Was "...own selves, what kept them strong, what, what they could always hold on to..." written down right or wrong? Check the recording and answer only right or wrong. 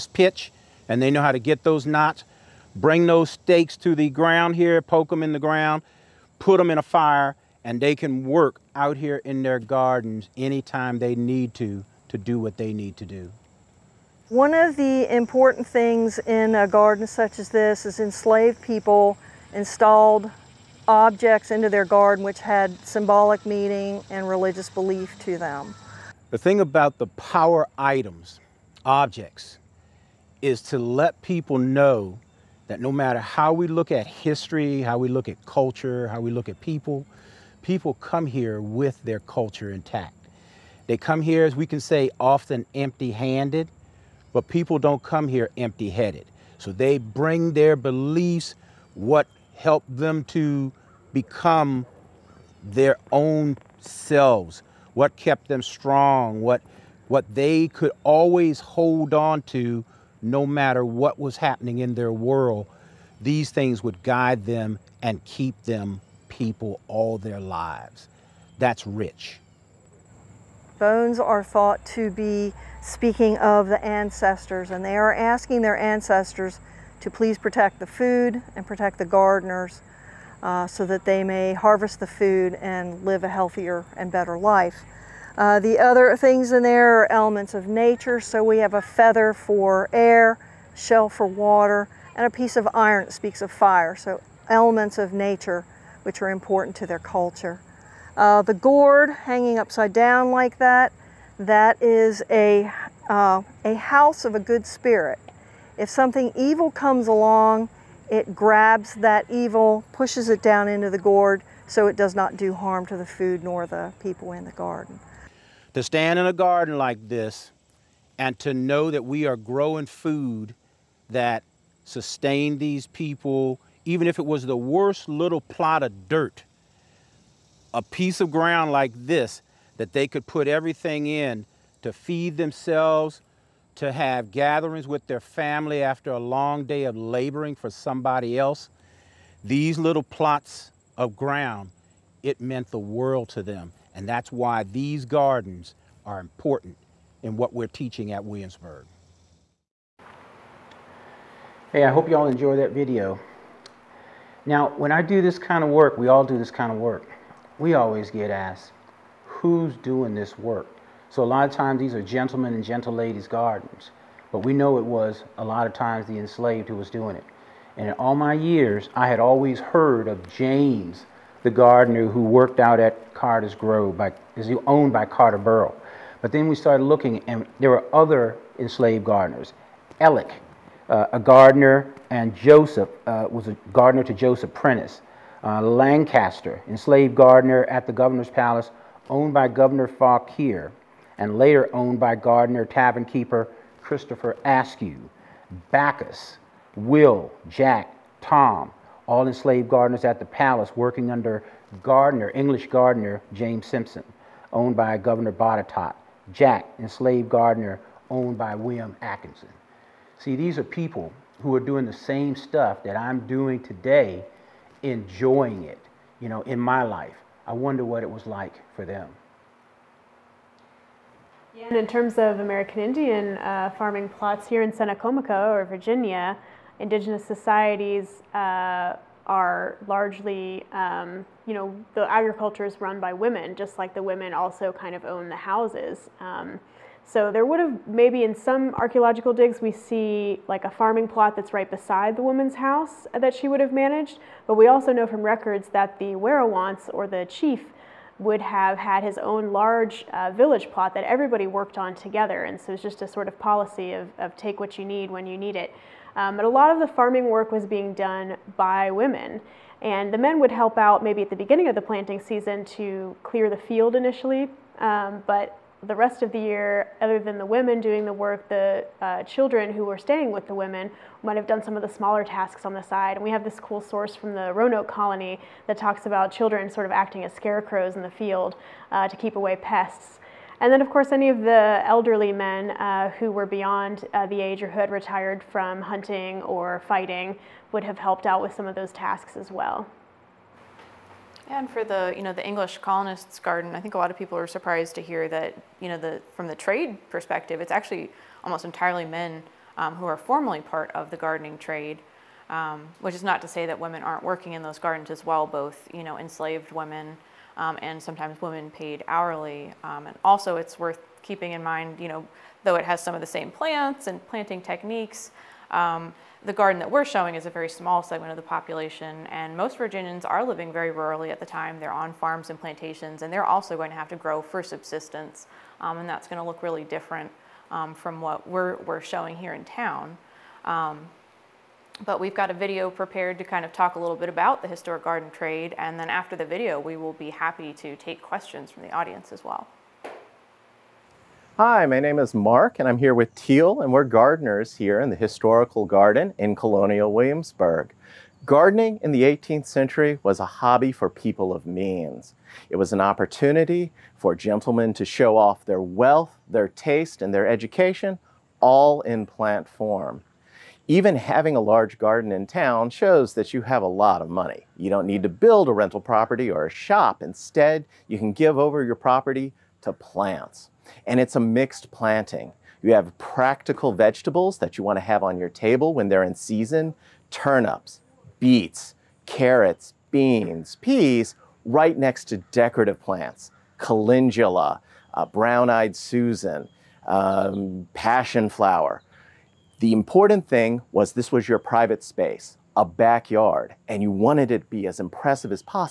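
right.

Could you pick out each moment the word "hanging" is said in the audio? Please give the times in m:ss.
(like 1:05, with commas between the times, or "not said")
1:39.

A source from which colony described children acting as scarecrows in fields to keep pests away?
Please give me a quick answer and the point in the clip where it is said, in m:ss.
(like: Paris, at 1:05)
Roanoke, at 4:34.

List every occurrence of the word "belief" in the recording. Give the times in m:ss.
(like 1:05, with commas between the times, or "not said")
0:24, 0:47.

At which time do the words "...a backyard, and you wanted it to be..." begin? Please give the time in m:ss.
6:32.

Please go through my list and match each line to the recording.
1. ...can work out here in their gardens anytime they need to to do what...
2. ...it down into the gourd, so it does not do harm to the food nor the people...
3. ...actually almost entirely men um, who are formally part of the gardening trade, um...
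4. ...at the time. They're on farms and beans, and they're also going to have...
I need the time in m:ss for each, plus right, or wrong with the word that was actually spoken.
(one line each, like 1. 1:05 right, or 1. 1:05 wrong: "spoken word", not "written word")
1. 0:07 right
2. 1:50 right
3. 4:57 right
4. 5:21 wrong: "plantations", not "beans".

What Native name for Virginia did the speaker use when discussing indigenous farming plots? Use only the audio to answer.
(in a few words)
Tsenacomoco.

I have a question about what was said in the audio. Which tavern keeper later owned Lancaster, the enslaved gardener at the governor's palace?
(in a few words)
Christopher Ayscough.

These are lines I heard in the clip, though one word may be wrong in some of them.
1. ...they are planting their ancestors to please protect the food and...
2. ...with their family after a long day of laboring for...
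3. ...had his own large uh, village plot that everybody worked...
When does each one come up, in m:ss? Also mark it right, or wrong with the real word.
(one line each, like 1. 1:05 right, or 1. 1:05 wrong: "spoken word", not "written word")
1. 1:14 wrong: "asking", not "planting"
2. 2:14 right
3. 4:08 right.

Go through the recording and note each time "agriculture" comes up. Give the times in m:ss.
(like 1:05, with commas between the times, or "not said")
3:52.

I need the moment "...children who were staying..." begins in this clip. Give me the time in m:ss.
4:29.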